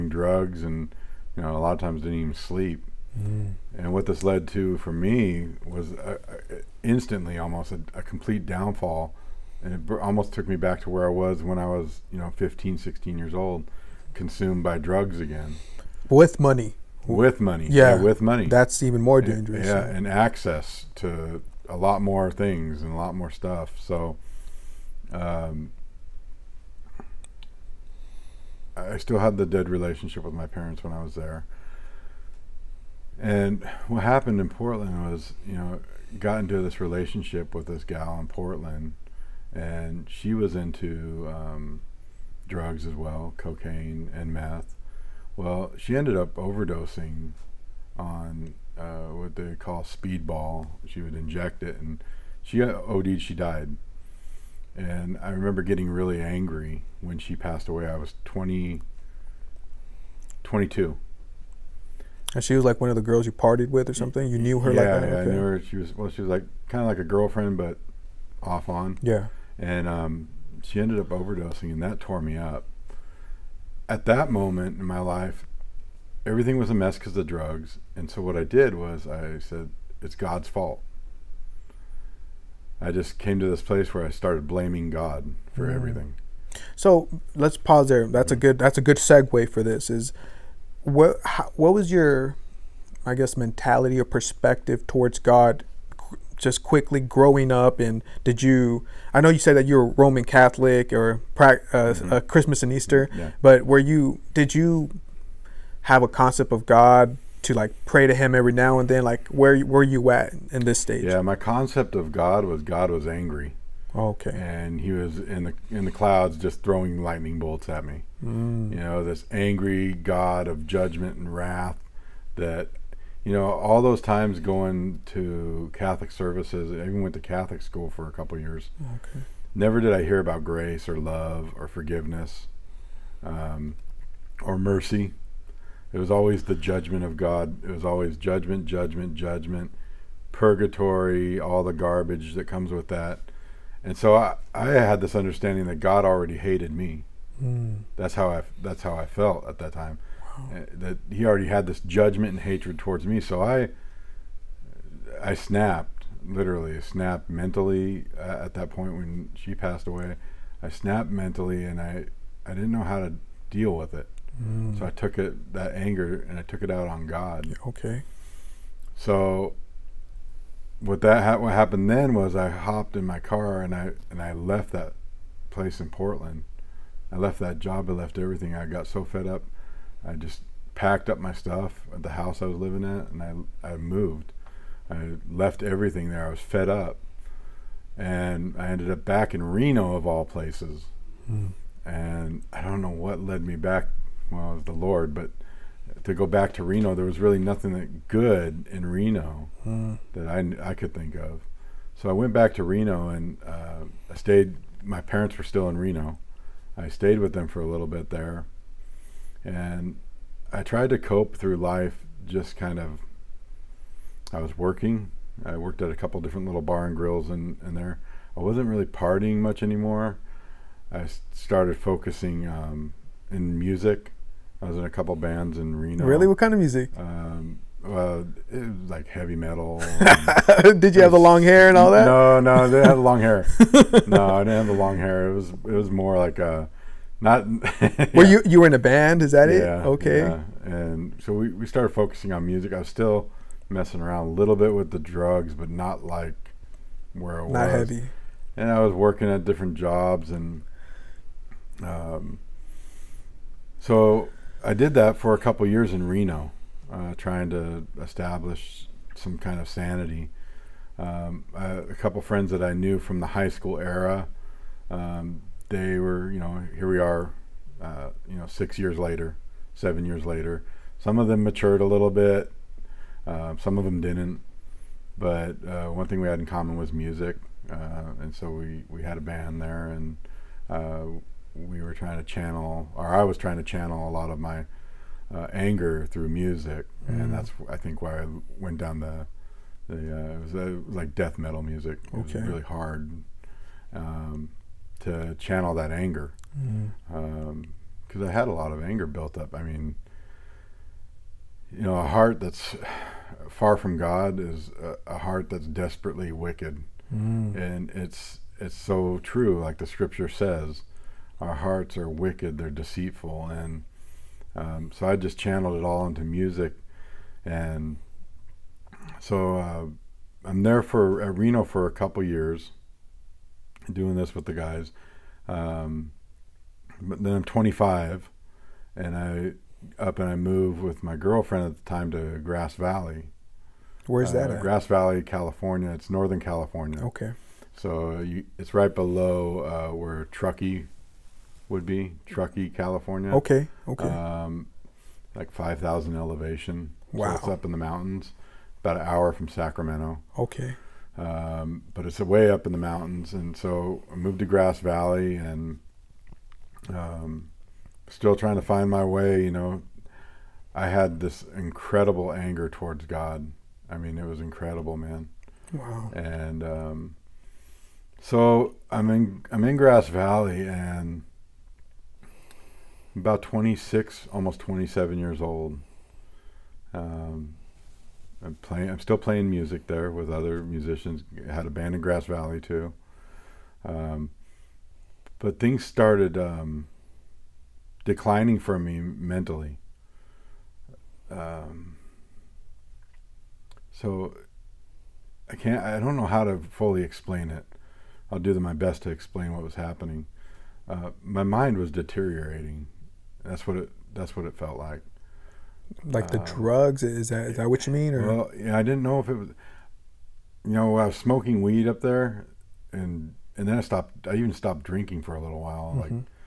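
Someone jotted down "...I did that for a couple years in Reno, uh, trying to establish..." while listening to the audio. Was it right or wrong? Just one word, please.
right.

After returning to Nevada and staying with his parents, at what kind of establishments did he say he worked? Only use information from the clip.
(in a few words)
Bar and grills.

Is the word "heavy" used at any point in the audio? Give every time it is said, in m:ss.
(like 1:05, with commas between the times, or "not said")
3:49, 4:07.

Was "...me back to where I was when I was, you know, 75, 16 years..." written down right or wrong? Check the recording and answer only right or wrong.
wrong.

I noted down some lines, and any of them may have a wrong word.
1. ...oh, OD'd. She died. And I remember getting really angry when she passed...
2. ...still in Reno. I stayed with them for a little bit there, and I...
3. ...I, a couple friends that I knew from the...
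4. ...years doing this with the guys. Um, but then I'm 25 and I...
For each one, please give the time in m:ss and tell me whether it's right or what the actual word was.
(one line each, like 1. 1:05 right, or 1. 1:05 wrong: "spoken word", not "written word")
1. 0:52 right
2. 3:25 right
3. 4:21 right
4. 5:22 right.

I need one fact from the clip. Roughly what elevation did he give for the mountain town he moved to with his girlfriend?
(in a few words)
5,000.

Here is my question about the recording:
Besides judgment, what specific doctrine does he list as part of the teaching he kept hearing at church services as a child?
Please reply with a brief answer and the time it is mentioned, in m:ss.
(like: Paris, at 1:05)
Purgatory, at 2:20.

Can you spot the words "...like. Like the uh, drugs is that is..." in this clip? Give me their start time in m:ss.
6:44.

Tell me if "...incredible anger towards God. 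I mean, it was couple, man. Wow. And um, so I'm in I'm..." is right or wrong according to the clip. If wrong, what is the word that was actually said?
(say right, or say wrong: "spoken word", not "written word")
wrong: "incredible", not "couple".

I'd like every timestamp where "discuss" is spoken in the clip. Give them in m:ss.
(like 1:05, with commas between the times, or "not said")
not said.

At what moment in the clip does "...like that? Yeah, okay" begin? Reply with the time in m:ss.
1:04.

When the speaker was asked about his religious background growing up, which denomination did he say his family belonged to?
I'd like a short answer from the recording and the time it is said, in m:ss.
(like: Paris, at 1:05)
Roman Catholic, at 1:39.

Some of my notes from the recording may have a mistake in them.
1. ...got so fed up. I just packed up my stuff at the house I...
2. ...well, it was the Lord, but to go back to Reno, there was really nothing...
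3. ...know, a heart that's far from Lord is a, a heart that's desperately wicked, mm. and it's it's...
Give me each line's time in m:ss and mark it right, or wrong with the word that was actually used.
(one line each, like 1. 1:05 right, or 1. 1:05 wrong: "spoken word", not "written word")
1. 2:58 right
2. 3:14 right
3. 5:01 wrong: "God", not "Lord".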